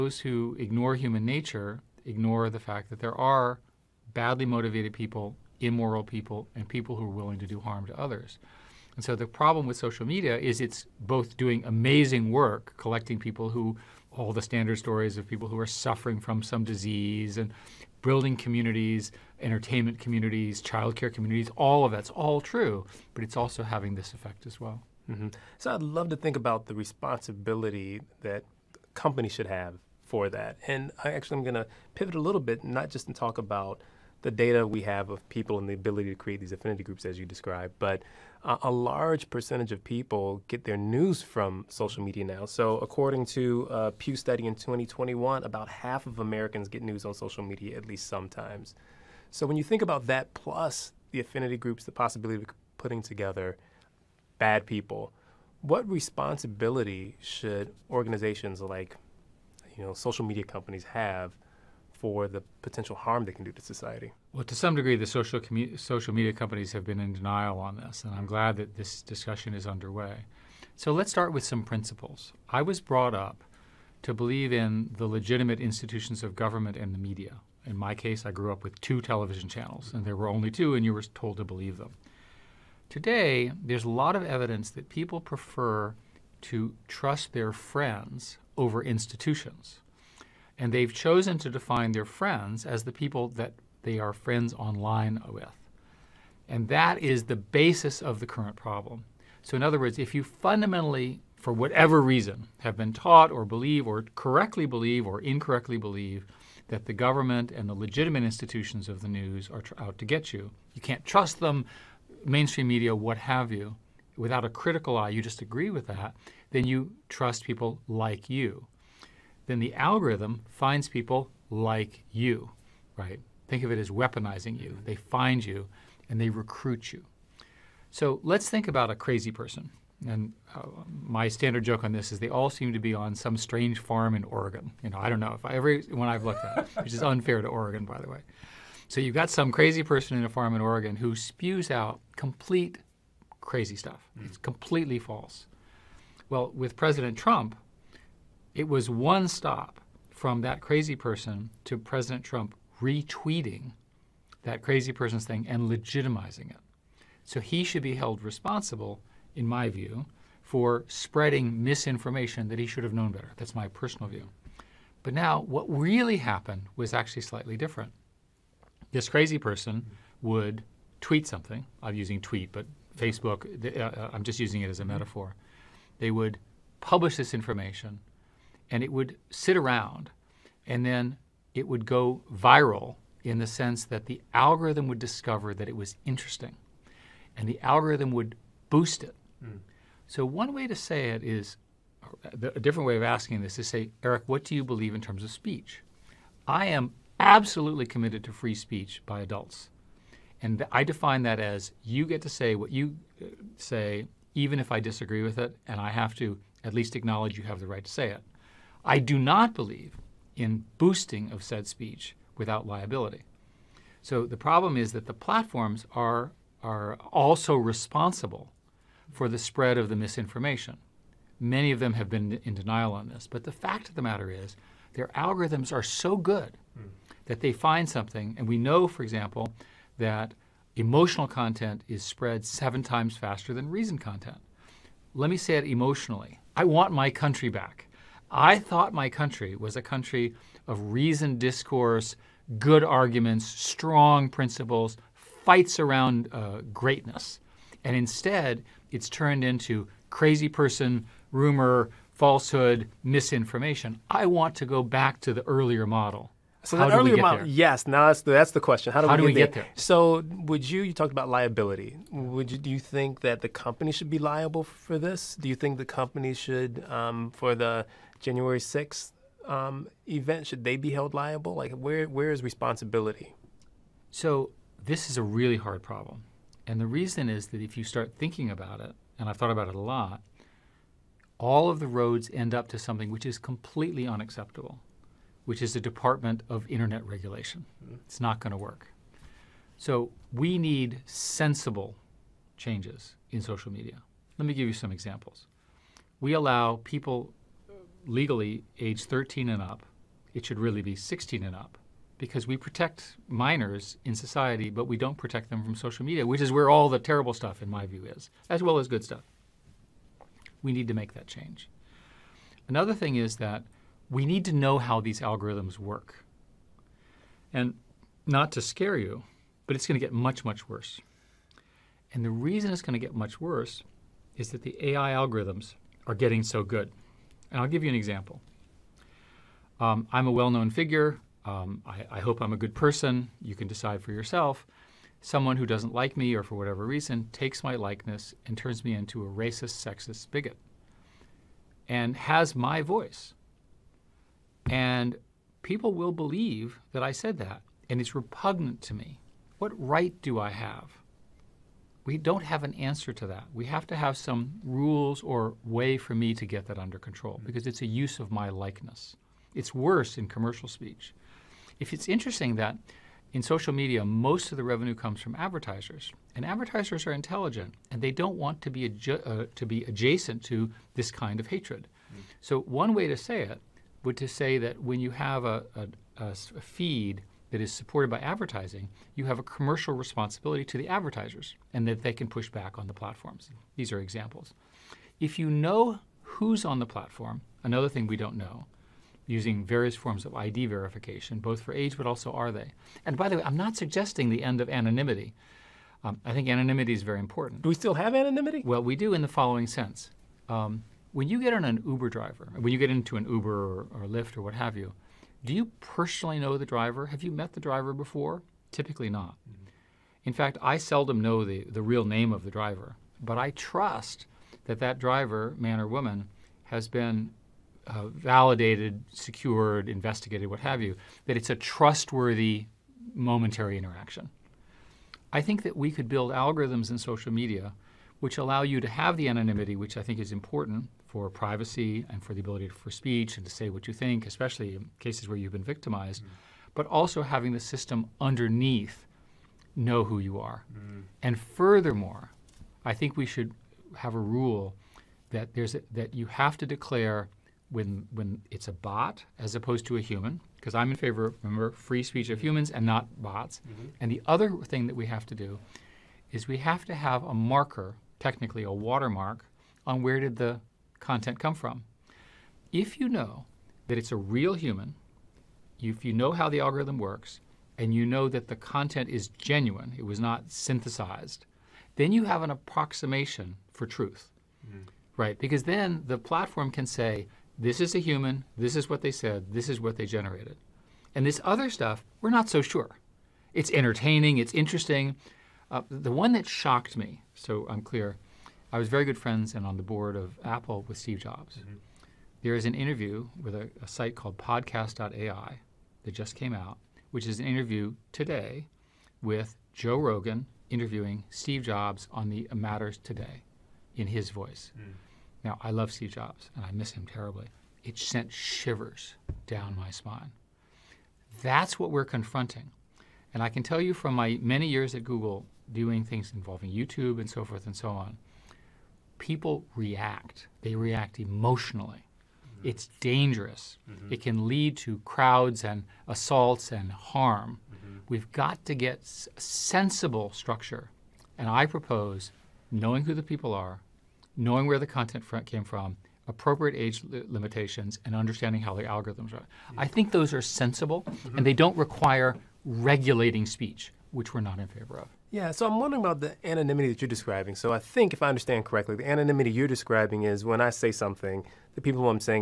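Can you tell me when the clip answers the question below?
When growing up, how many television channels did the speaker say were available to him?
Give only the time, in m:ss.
1:18.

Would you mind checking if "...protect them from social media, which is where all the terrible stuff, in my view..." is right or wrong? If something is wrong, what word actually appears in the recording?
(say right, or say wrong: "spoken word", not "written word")
right.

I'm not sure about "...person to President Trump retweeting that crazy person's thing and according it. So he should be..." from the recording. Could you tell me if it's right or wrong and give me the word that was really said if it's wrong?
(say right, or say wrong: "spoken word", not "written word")
wrong: "legitimizing", not "according".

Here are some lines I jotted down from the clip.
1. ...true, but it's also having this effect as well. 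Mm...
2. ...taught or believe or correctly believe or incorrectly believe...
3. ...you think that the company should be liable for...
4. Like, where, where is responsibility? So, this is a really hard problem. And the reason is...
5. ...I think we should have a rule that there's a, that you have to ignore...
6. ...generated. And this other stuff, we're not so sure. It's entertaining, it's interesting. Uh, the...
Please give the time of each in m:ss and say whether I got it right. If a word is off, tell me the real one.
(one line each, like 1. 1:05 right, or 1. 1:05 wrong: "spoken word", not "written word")
1. 0:22 right
2. 1:42 right
3. 4:22 right
4. 4:31 right
5. 7:22 wrong: "declare", not "ignore"
6. 8:00 right.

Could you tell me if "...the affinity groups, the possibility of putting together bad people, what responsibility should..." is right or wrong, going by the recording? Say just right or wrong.
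right.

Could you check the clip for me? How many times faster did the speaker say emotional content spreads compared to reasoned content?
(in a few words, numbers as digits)
7.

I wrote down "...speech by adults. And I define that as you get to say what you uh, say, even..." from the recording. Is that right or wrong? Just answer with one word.
right.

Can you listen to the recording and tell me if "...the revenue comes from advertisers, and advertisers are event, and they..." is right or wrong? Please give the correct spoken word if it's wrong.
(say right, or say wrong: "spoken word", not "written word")
wrong: "intelligent", not "event".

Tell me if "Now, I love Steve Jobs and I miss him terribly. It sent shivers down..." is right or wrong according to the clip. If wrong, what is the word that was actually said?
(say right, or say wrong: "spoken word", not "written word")
right.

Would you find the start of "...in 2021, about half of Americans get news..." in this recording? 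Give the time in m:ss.
0:44.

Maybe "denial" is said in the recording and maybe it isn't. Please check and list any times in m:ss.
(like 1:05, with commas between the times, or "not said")
1:07, 3:42.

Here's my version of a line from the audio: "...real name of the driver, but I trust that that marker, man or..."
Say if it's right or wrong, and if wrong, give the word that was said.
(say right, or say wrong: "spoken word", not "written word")
wrong: "driver", not "marker".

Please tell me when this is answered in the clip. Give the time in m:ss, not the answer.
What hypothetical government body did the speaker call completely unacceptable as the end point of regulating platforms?
4:45.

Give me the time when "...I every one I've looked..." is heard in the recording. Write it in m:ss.
2:15.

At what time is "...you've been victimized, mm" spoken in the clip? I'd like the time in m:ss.
7:15.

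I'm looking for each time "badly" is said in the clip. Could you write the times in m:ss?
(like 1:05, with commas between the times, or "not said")
0:04.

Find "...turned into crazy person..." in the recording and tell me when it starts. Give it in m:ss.
4:09.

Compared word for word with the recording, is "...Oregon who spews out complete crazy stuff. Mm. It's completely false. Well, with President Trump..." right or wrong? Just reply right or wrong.
right.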